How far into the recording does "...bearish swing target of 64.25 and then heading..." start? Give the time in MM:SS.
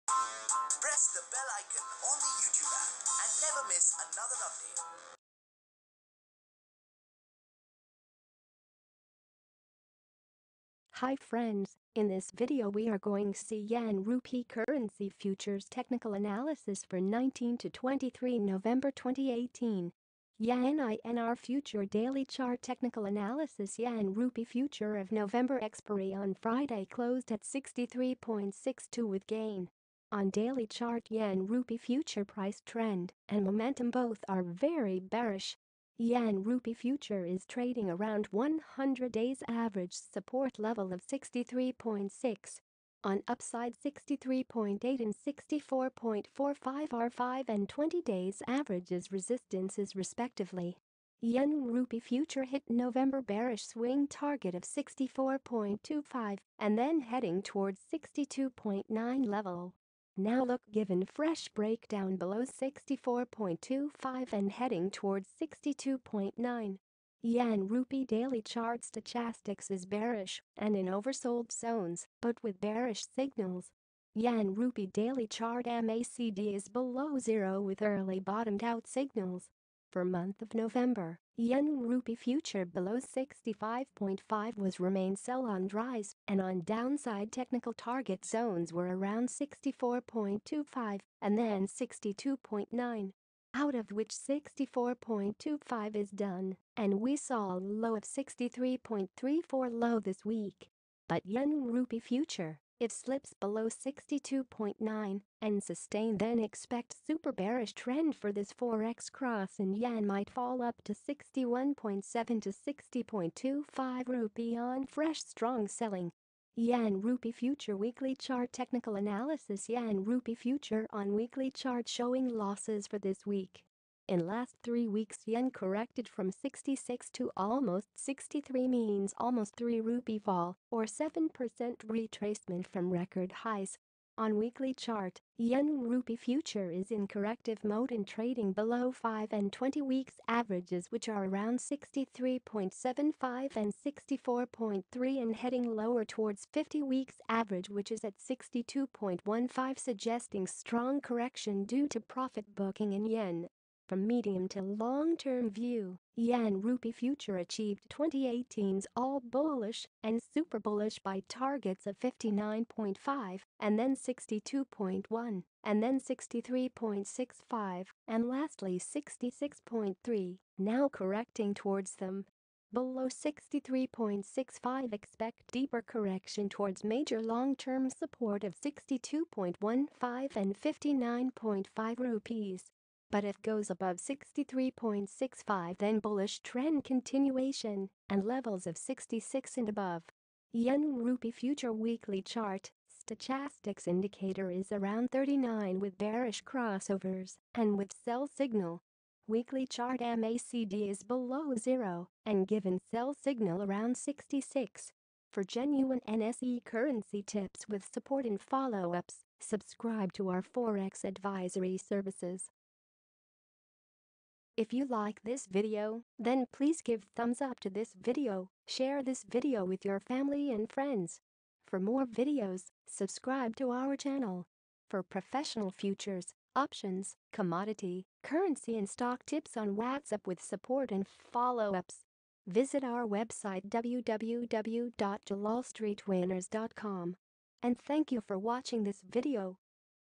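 00:53.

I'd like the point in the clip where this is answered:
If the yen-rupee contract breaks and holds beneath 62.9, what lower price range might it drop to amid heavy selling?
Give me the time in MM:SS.
01:50.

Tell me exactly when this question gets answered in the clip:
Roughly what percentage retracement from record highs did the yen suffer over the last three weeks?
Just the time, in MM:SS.
02:10.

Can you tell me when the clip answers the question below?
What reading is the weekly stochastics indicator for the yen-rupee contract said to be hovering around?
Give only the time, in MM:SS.
03:15.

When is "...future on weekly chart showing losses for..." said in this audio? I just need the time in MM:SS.
02:00.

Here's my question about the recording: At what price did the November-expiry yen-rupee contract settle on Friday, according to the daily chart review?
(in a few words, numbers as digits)
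63.62.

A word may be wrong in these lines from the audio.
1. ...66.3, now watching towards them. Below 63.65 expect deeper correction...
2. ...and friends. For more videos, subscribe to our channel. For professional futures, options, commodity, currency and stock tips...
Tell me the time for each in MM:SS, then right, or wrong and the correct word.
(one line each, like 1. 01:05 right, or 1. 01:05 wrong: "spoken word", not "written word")
1. 02:48 wrong: "correcting", not "watching"
2. 03:40 right.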